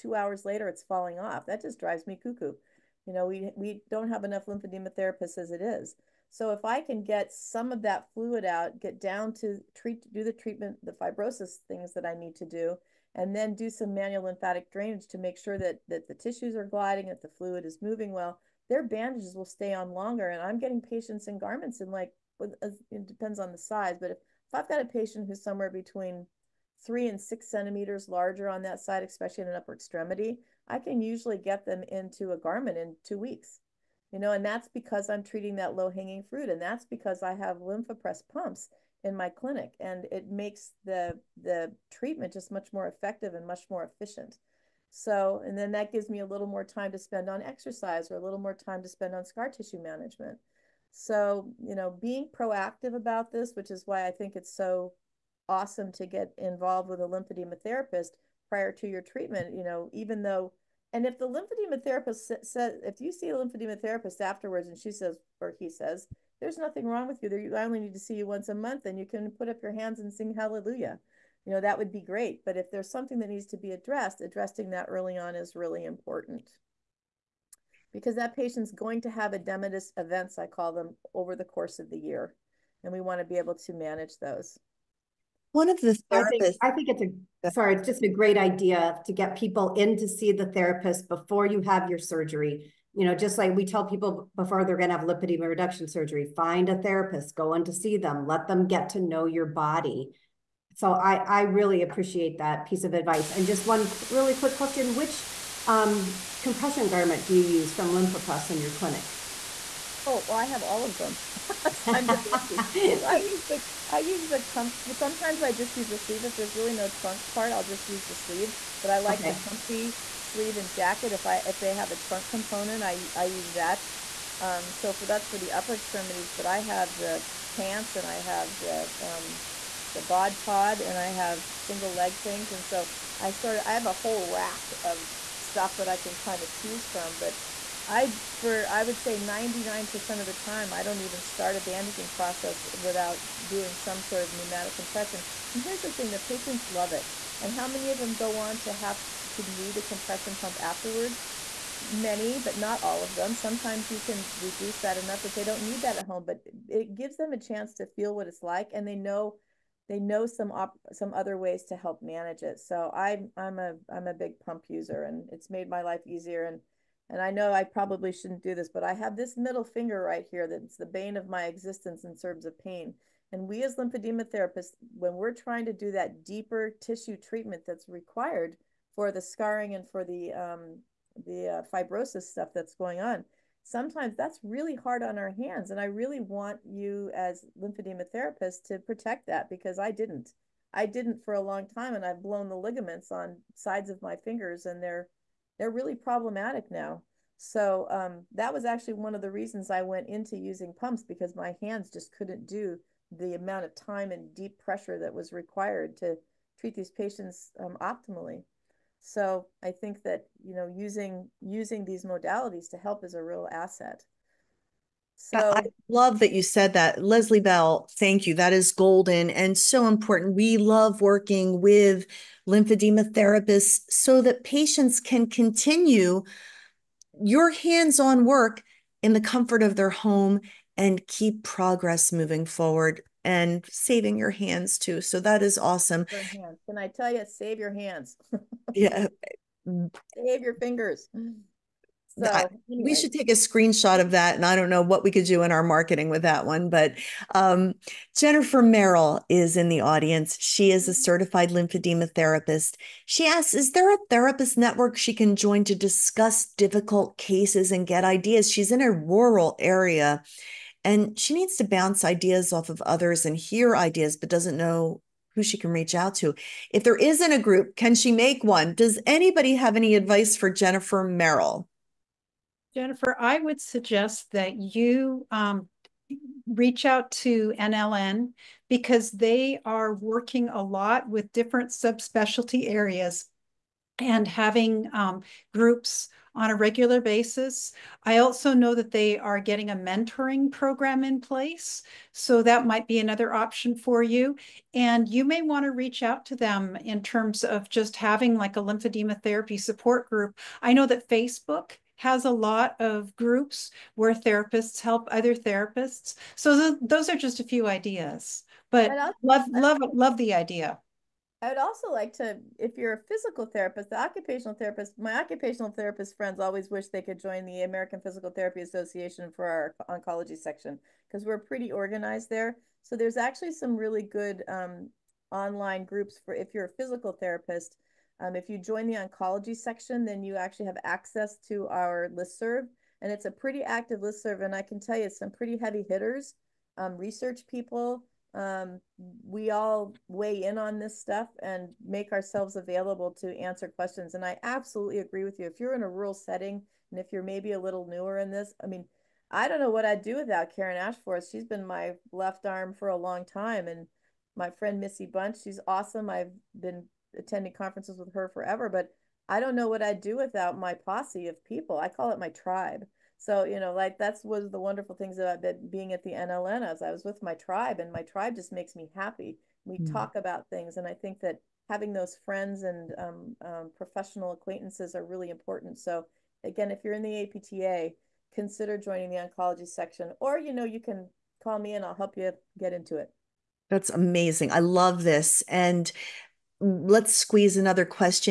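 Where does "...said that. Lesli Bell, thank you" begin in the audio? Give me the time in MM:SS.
03:36.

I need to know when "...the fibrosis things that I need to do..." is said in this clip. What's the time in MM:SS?
00:10.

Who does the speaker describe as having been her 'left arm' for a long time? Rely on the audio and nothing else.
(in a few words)
Karen Ashforth.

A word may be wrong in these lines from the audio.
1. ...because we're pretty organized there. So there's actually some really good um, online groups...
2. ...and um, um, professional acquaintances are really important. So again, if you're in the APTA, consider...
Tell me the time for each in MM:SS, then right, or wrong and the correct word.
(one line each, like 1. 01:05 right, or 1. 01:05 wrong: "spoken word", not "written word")
1. 05:21 right
2. 06:12 right.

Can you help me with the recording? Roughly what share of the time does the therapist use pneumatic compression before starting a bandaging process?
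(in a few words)
99%.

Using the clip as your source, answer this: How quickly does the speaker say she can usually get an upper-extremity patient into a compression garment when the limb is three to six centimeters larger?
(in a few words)
2 weeks.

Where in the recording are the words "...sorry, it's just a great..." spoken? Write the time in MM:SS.
01:27.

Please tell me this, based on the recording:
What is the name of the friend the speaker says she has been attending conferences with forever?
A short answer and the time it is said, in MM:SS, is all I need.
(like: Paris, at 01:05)
Missy Bunch, at 05:54.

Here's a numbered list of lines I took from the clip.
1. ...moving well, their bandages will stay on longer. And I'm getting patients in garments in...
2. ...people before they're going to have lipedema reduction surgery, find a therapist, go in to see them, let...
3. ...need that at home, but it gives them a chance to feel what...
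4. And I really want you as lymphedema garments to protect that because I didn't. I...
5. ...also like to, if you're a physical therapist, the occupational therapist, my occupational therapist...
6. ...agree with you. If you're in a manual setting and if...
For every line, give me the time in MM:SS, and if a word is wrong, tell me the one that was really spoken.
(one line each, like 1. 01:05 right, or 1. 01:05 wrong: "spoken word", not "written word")
1. 00:17 right
2. 01:33 right
3. 02:35 right
4. 03:05 wrong: "therapists", not "garments"
5. 05:11 right
6. 05:44 wrong: "rural", not "manual".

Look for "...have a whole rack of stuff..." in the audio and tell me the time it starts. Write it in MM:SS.
02:13.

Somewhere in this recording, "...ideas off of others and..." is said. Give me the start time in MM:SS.
04:22.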